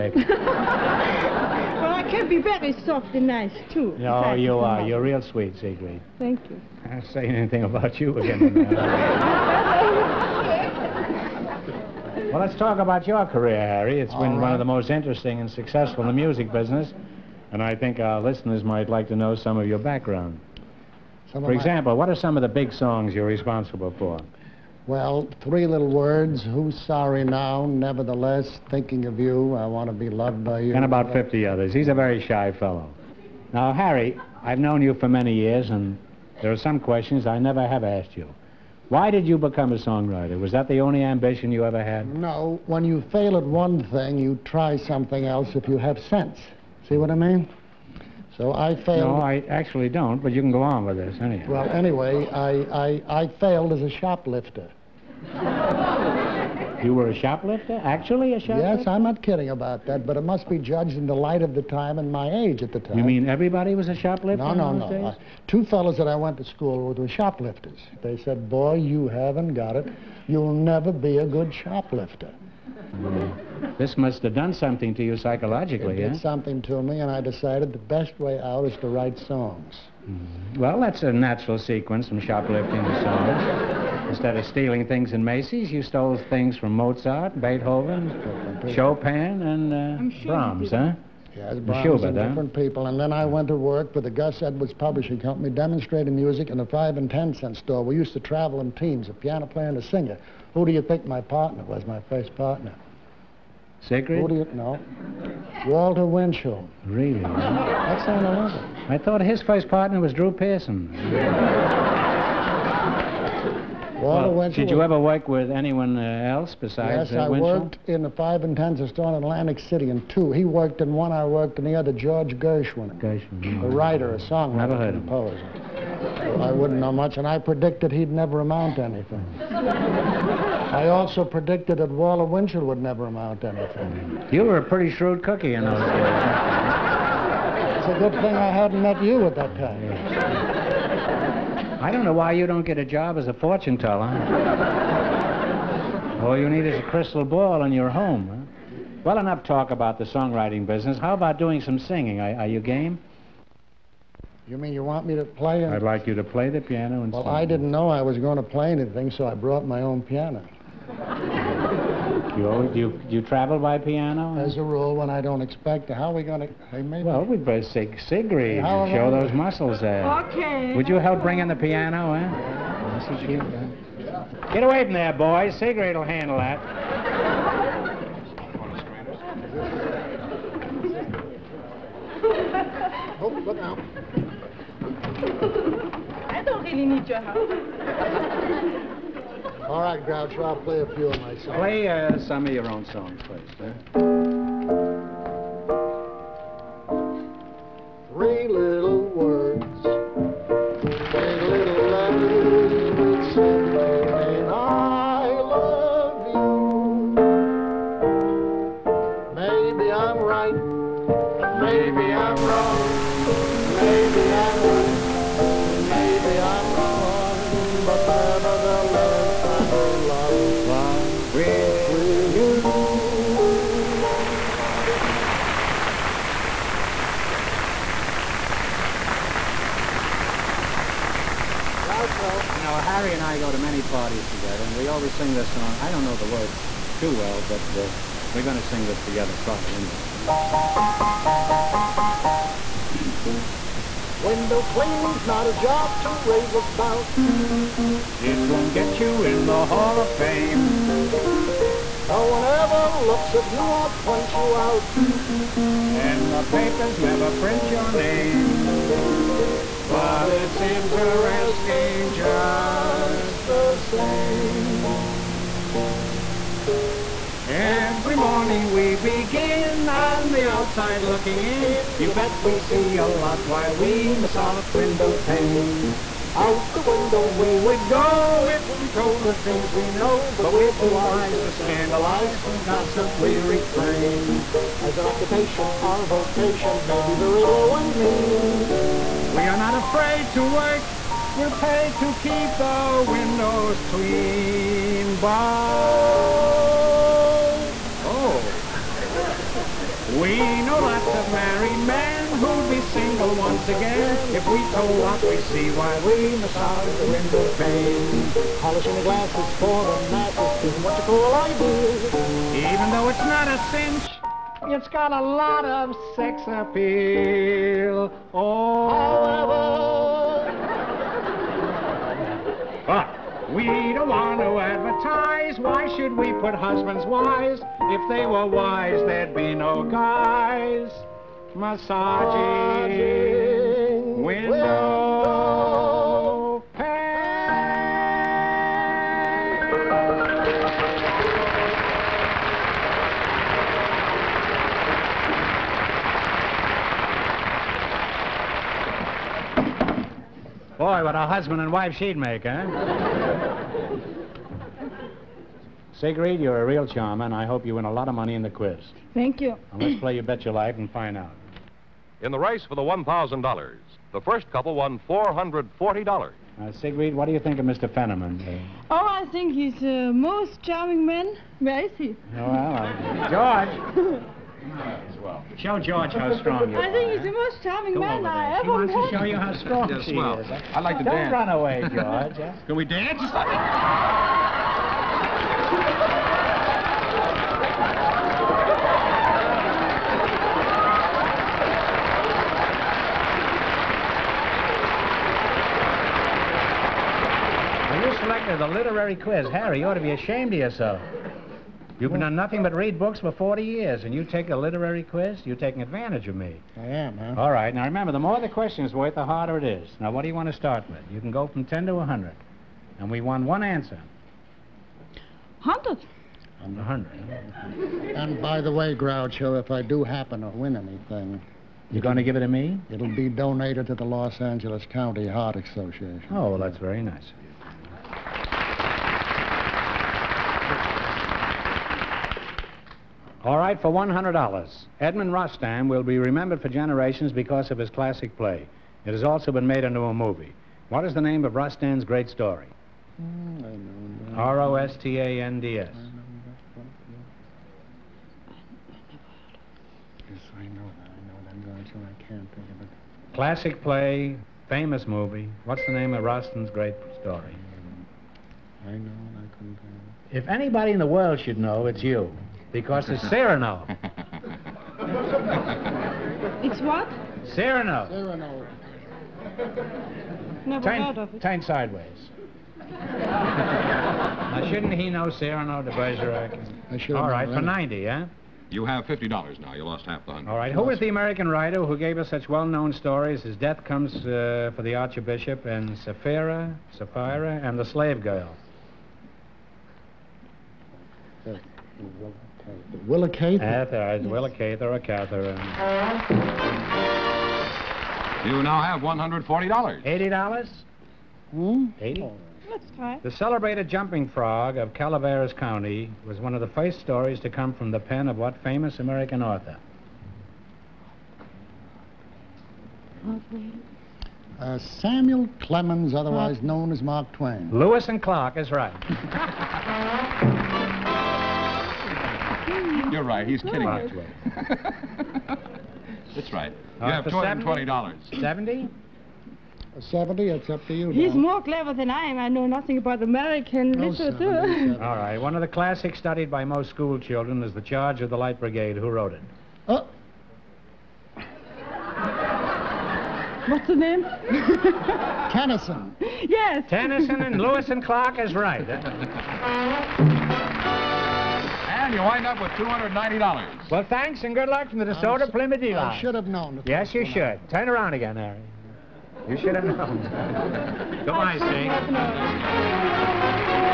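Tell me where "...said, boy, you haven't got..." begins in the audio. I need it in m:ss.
1:08.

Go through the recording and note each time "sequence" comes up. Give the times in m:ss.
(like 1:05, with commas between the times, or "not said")
1:21.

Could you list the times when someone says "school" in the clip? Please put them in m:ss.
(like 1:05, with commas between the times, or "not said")
1:06, 8:56.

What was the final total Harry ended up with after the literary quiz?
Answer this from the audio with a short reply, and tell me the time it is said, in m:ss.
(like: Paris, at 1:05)
$290, at 9:12.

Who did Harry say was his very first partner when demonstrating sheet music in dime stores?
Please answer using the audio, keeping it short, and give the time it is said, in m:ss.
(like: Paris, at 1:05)
Walter Winchell, at 1:45.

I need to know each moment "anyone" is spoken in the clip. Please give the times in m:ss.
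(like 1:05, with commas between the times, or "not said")
1:55.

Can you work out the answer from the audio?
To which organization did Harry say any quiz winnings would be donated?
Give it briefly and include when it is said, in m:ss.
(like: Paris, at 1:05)
Los Angeles County Heart Association, at 7:04.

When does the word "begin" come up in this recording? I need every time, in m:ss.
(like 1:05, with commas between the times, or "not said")
4:28.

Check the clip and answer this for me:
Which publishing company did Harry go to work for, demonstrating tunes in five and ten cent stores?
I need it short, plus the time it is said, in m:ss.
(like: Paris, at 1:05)
Gus Edwards Publishing Company, at 1:34.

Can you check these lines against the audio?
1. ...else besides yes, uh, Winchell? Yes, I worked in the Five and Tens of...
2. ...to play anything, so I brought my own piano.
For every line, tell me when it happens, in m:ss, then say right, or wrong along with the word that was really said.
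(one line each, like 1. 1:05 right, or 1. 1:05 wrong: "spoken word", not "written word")
1. 1:56 right
2. 2:38 right.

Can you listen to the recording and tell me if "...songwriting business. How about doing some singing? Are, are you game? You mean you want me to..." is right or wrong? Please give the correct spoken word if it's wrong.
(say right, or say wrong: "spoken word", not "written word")
right.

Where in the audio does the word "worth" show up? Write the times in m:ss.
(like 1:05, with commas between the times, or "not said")
6:48.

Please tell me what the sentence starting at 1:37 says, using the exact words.
We used to travel in teams, a piano player and a singer.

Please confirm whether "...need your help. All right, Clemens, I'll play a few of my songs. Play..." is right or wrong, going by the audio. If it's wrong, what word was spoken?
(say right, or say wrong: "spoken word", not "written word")
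wrong: "Groucho", not "Clemens".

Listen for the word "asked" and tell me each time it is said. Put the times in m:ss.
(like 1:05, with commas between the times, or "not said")
0:37.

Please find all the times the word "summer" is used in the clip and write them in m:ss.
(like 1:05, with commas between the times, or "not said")
not said.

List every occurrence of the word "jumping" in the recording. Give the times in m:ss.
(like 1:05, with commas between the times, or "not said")
8:23.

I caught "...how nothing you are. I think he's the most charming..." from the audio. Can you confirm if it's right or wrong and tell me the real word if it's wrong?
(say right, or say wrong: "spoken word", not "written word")
wrong: "strong", not "nothing".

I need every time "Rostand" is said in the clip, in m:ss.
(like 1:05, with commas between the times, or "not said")
7:15, 7:21, 7:36.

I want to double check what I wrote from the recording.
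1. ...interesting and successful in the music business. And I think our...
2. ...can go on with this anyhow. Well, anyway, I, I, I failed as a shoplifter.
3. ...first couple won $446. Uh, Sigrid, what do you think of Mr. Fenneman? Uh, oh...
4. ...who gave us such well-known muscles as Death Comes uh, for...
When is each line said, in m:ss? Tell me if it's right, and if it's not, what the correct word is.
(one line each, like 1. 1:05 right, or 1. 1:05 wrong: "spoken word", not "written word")
1. 0:14 right
2. 0:50 right
3. 6:04 wrong: "440", not "446"
4. 8:01 wrong: "stories", not "muscles".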